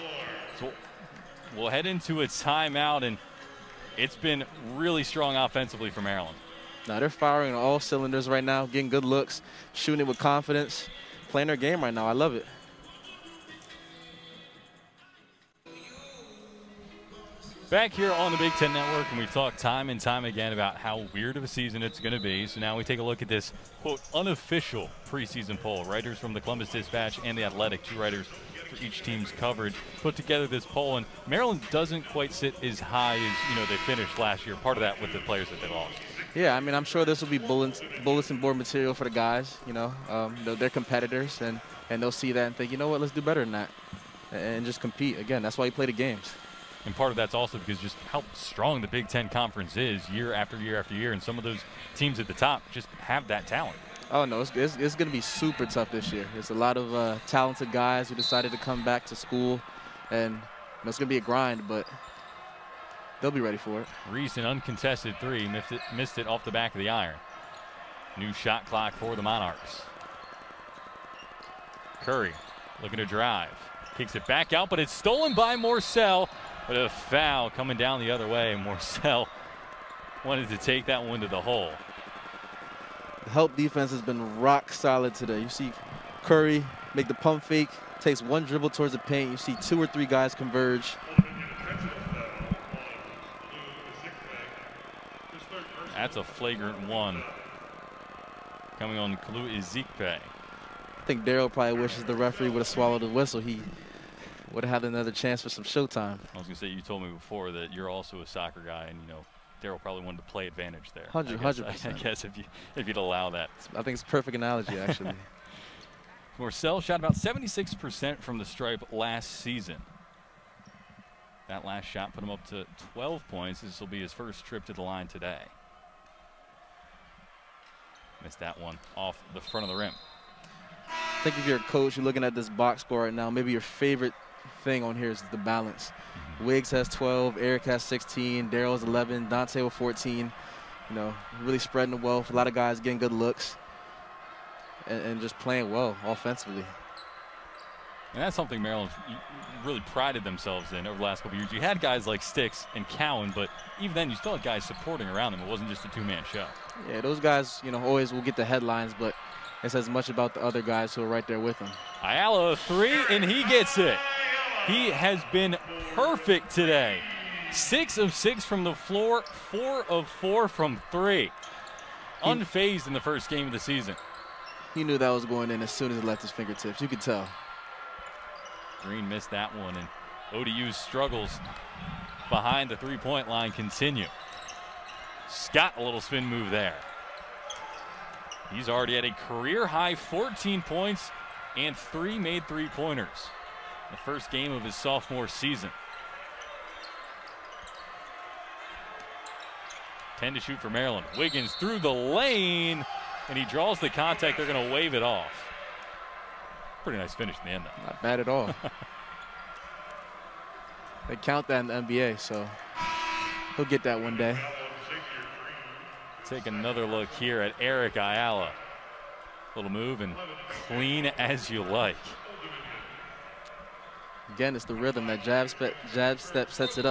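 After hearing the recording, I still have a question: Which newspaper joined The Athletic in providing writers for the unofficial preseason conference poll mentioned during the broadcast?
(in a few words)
Columbus Dispatch.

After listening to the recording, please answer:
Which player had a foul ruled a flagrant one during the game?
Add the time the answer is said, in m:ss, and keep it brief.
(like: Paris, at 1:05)
Kalu Ezikpe, at 1:39.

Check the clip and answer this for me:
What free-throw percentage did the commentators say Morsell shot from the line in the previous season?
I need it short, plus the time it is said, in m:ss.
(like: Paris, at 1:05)
76%, at 1:57.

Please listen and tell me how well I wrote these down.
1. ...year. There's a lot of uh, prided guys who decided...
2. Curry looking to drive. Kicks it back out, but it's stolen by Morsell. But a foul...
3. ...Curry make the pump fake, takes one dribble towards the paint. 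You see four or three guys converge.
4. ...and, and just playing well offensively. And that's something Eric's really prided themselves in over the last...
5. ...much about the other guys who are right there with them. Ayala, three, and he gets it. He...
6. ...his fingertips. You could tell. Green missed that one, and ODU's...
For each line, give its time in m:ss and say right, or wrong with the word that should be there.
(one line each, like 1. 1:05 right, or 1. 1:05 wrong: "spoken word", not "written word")
1. 0:56 wrong: "talented", not "prided"
2. 1:12 right
3. 1:26 wrong: "two", not "four"
4. 2:24 wrong: "Maryland", not "Eric"
5. 2:39 right
6. 2:56 right.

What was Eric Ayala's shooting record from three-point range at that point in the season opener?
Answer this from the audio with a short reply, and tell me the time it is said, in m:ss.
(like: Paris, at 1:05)
4 of 4, at 2:49.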